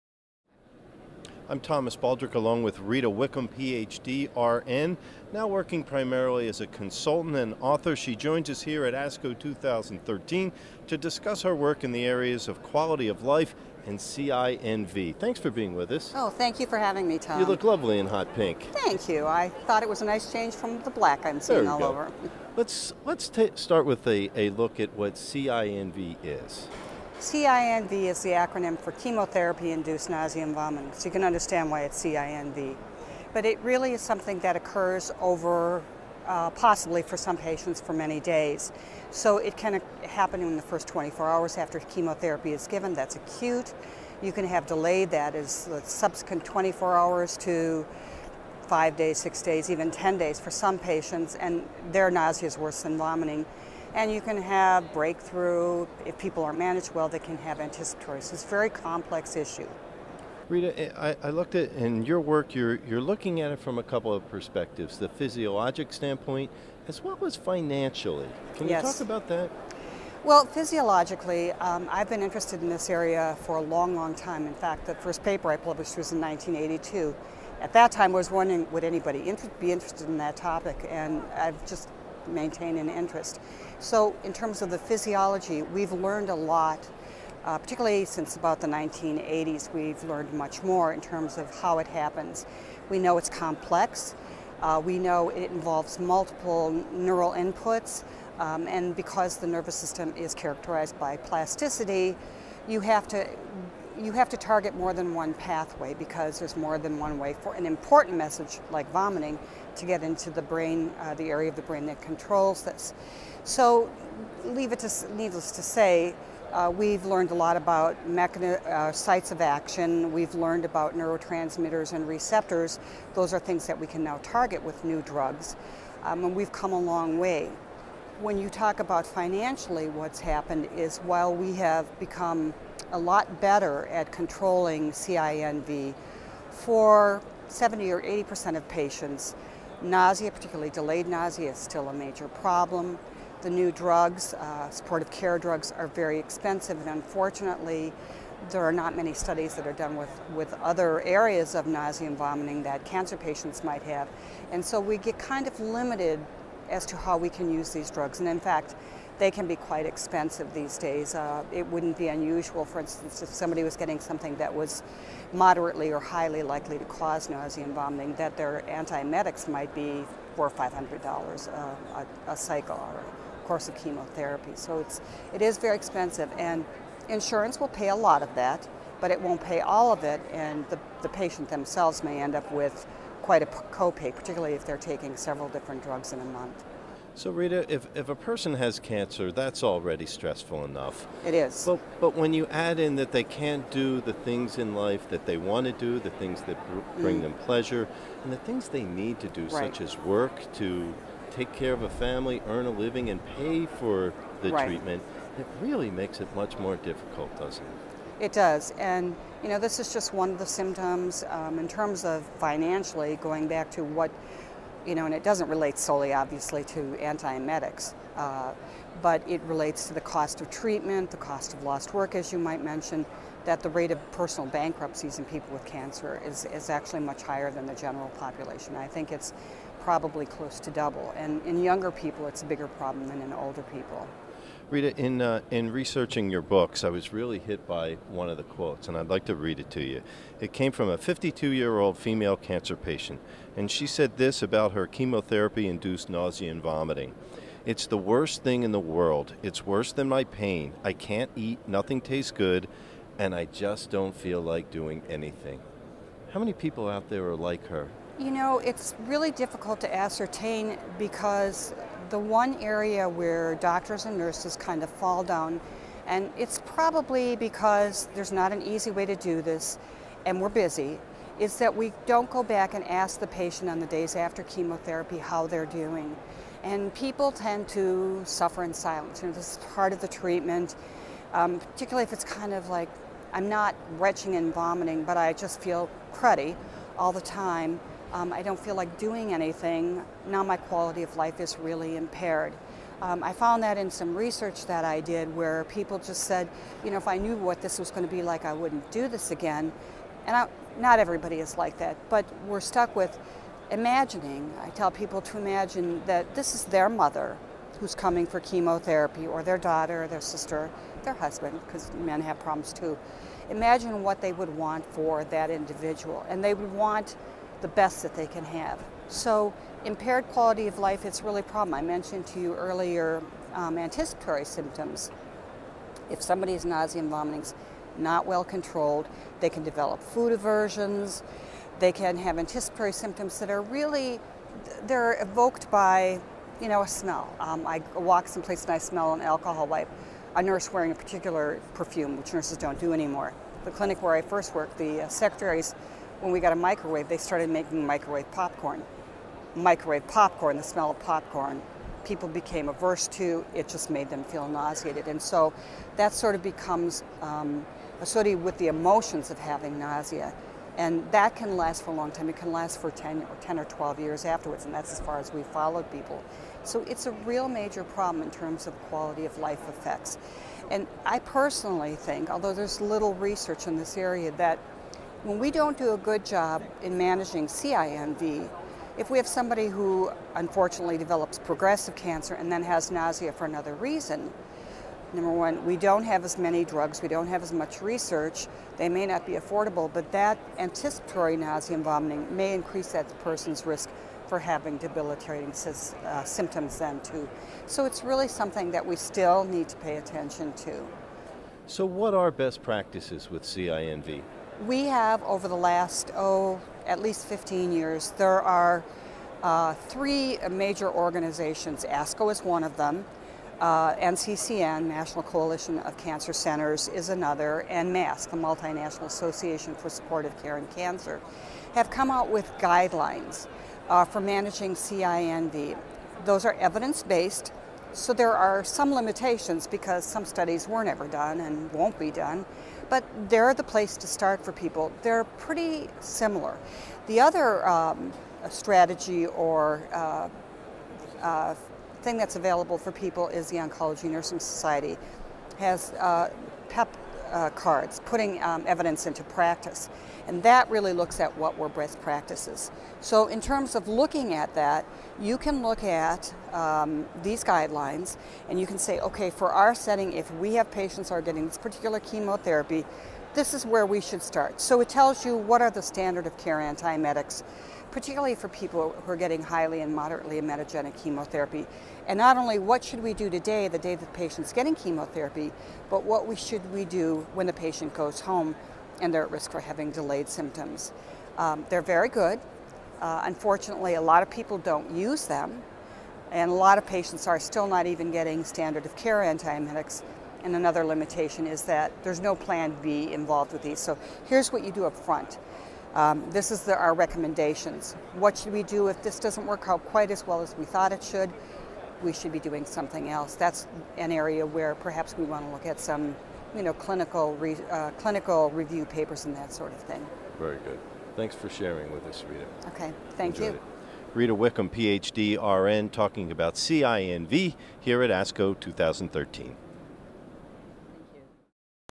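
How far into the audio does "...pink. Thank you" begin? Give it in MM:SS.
00:18.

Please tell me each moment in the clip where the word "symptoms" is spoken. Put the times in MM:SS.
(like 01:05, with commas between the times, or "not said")
03:30, 05:24, 05:32, 06:36, 08:00.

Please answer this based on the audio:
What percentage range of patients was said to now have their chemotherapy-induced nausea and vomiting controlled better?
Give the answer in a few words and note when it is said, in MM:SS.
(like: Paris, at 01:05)
70 or 80%, at 02:17.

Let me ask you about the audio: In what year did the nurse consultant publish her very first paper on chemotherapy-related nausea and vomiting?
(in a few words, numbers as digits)
1982.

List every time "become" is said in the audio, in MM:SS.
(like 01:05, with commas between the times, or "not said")
02:11, 05:56.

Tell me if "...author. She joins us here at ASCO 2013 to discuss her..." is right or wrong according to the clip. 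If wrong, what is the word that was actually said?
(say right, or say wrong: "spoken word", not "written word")
right.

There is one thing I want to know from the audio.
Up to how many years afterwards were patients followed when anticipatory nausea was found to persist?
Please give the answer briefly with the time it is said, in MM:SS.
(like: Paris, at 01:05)
12 years, at 06:03.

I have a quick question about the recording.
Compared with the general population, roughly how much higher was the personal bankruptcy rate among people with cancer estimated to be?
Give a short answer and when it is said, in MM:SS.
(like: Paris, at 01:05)
Close to double, at 03:50.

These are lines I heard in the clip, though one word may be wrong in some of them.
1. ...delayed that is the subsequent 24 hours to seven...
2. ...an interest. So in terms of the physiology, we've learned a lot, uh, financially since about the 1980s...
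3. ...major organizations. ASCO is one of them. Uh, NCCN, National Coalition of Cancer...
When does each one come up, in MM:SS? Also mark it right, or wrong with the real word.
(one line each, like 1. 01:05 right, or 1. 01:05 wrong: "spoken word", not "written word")
1. 00:44 wrong: "five", not "seven"
2. 01:22 wrong: "particularly", not "financially"
3. 06:50 right.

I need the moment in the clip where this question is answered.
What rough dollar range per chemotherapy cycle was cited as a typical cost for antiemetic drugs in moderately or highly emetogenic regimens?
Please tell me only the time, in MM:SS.
02:50.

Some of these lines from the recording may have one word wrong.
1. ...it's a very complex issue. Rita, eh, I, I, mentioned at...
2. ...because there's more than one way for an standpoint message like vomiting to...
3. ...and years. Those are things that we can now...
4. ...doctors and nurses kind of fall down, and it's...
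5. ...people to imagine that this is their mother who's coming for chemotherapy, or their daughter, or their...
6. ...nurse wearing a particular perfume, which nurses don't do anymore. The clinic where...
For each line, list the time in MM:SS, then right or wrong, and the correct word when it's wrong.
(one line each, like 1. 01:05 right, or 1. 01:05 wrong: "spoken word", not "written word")
1. 00:58 wrong: "looked", not "mentioned"
2. 01:45 wrong: "important", not "standpoint"
3. 02:01 wrong: "receptors", not "years"
4. 04:23 right
5. 05:04 right
6. 05:40 right.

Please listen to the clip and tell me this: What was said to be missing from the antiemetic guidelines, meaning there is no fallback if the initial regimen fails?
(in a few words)
Plan B.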